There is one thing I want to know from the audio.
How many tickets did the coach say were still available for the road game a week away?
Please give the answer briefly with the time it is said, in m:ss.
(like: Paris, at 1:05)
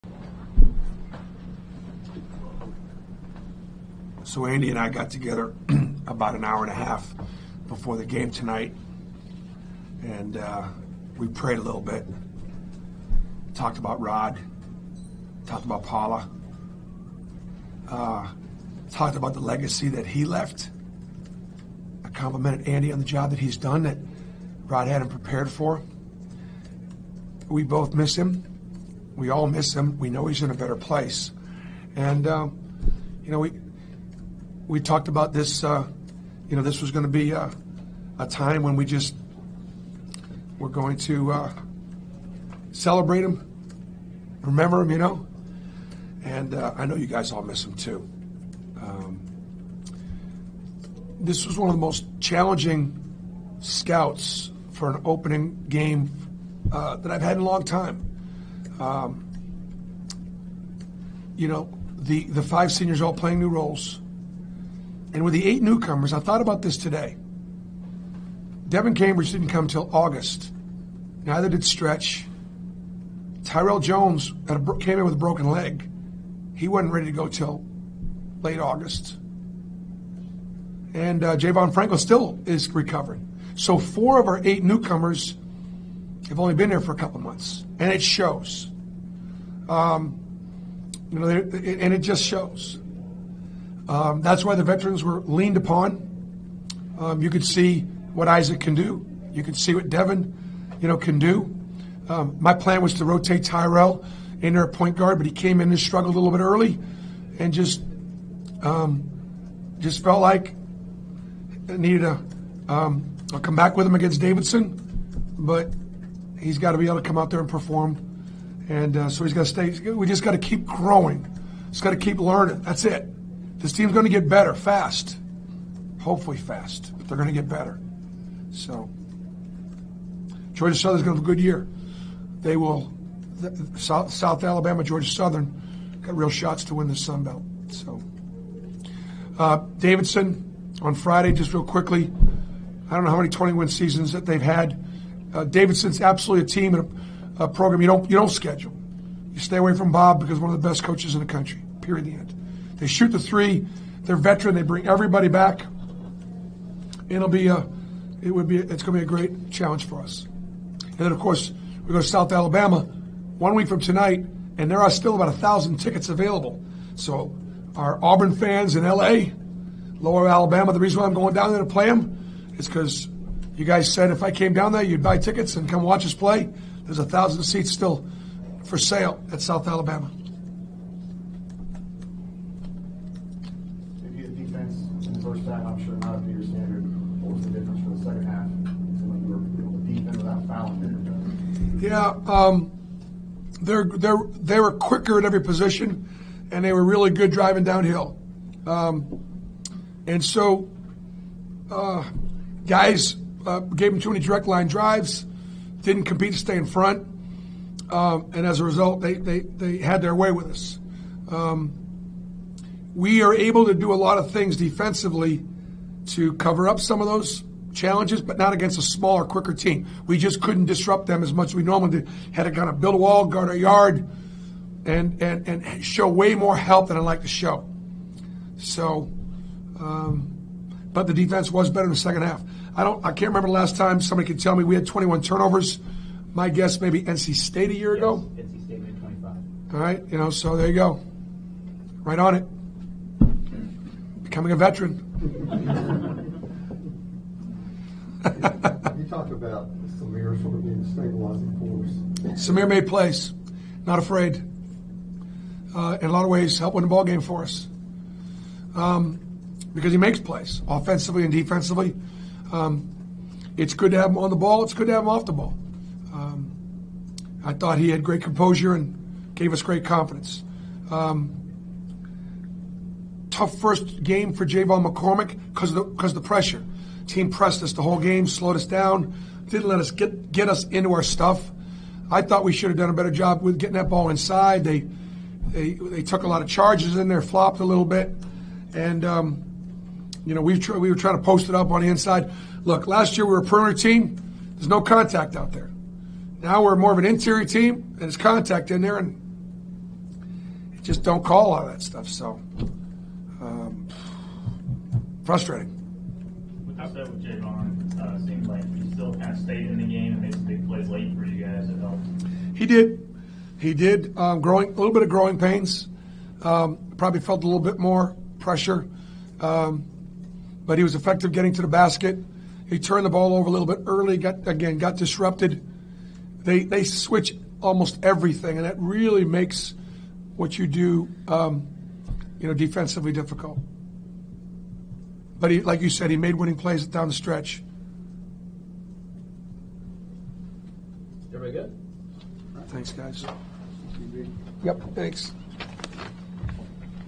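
1000, at 2:45.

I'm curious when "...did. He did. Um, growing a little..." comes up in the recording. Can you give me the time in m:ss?
5:12.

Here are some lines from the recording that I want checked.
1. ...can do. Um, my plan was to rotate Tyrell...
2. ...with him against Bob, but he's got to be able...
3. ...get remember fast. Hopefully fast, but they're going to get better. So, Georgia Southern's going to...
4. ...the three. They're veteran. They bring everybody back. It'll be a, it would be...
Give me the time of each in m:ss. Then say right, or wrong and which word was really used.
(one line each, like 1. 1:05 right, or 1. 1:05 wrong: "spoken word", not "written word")
1. 1:40 right
2. 1:53 wrong: "Davidson", not "Bob"
3. 2:04 wrong: "better", not "remember"
4. 2:33 right.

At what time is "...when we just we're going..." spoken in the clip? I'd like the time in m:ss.
0:38.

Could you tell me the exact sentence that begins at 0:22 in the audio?
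I complimented Andy on the job that he's done that Rod had him prepared for.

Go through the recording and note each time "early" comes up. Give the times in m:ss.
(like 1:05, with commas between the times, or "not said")
1:46, 5:23.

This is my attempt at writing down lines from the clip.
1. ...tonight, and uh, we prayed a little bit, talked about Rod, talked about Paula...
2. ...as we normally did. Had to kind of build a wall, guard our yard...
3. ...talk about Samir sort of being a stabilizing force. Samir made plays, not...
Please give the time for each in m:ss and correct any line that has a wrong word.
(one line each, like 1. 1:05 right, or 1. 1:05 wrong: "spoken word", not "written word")
1. 0:08 right
2. 3:41 right
3. 4:09 right.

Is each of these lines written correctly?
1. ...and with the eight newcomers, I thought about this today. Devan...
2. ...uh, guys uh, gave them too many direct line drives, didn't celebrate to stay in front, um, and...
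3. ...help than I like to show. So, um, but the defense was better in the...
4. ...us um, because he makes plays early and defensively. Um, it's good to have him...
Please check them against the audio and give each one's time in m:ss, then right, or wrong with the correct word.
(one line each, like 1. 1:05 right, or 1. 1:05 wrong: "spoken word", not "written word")
1. 1:05 right
2. 3:21 wrong: "compete", not "celebrate"
3. 3:46 right
4. 4:17 wrong: "offensively", not "early".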